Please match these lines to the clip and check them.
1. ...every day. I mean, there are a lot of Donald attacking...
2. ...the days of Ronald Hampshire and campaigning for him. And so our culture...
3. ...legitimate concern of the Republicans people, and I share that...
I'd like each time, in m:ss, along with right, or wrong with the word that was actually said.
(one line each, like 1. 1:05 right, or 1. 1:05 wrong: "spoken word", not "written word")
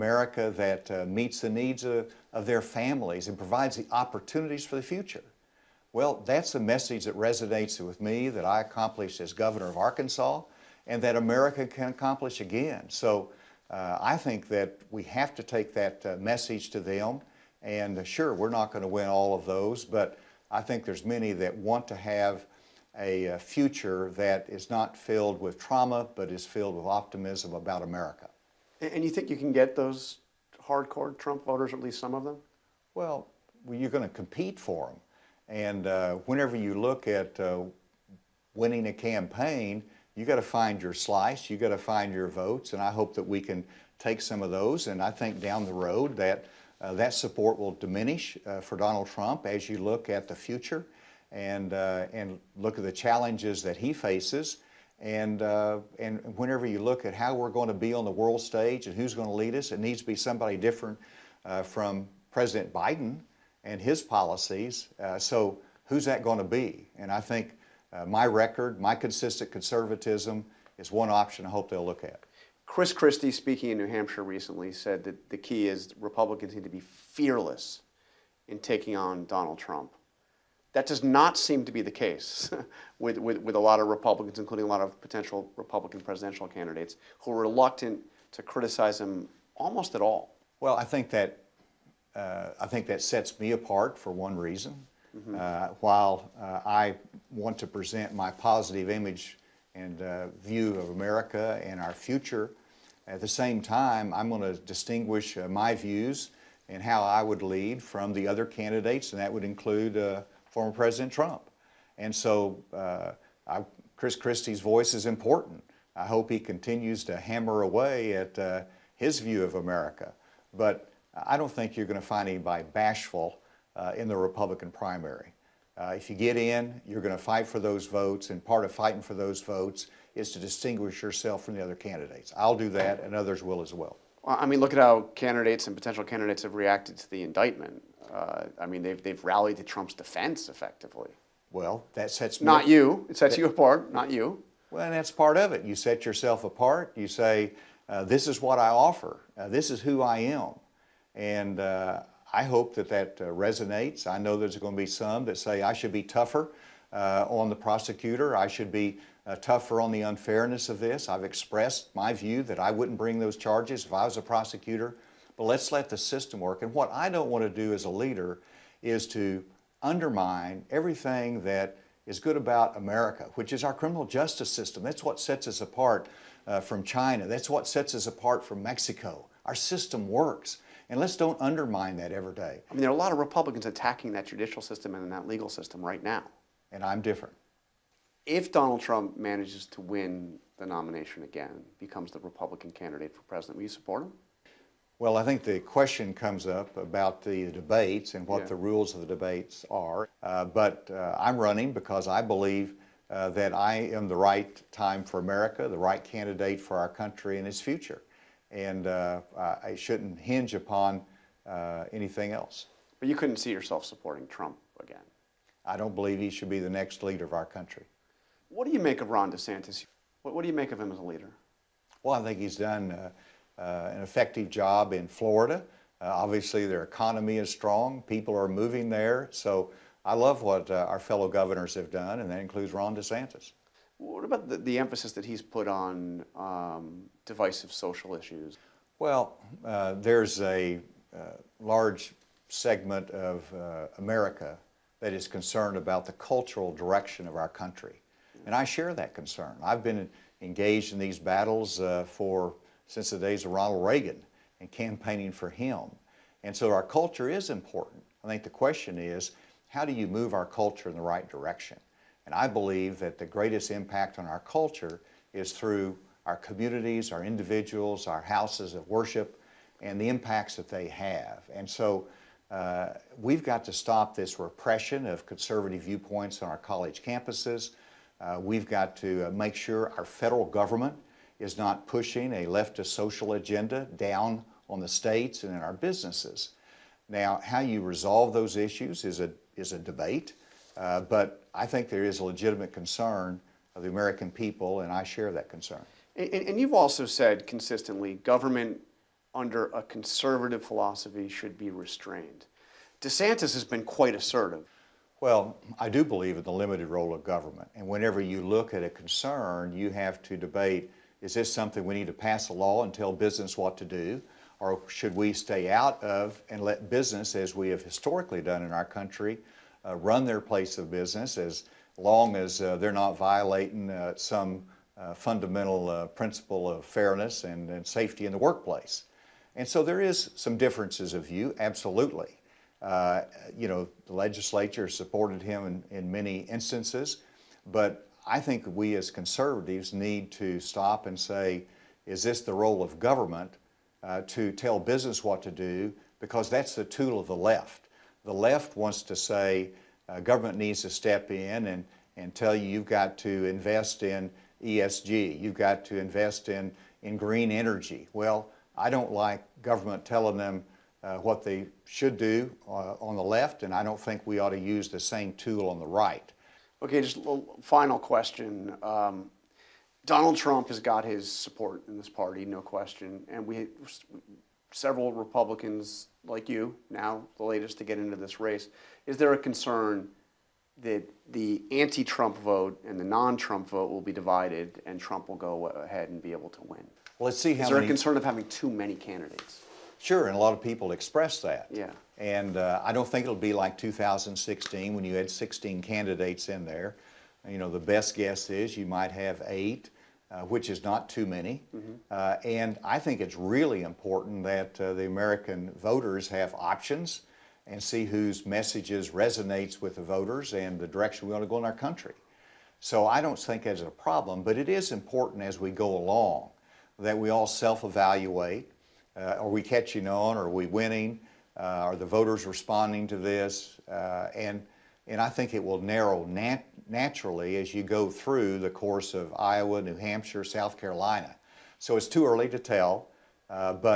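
1. 3:02 wrong: "Republicans", not "Donald"
2. 4:13 wrong: "Reagan", not "Hampshire"
3. 4:52 wrong: "American", not "Republicans".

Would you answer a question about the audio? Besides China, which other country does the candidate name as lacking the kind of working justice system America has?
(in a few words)
Mexico.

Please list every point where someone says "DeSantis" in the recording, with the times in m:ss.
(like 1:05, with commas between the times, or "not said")
3:39, 3:52, 5:03.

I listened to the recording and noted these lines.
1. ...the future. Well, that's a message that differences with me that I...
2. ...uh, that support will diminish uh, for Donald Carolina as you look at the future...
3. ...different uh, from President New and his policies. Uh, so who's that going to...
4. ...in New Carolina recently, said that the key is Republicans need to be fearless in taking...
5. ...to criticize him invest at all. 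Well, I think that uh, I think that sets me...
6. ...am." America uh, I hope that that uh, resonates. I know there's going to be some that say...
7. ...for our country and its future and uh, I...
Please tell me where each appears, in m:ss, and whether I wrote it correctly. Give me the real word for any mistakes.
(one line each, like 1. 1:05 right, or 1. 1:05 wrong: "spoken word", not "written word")
1. 0:04 wrong: "resonates", not "differences"
2. 0:46 wrong: "Trump", not "Carolina"
3. 1:00 wrong: "Biden", not "New"
4. 1:13 wrong: "Hampshire", not "Carolina"
5. 1:28 wrong: "almost", not "invest"
6. 2:30 wrong: "And", not "America"
7. 3:26 right.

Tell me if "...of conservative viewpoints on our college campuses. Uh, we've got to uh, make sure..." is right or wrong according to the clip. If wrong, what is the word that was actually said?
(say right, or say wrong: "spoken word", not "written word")
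right.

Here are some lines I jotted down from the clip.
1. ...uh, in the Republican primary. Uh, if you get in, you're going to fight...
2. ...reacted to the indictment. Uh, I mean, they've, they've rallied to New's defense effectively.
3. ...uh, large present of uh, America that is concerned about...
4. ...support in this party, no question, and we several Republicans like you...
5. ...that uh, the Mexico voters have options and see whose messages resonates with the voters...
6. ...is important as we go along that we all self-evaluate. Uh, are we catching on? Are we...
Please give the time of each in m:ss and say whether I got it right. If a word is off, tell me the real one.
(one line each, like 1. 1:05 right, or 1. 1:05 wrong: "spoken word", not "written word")
1. 2:03 right
2. 2:16 wrong: "Trump", not "New"
3. 4:01 wrong: "segment", not "present"
4. 6:11 right
5. 6:44 wrong: "American", not "Mexico"
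6. 6:54 right.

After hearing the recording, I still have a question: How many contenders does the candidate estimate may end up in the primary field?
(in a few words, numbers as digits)
8.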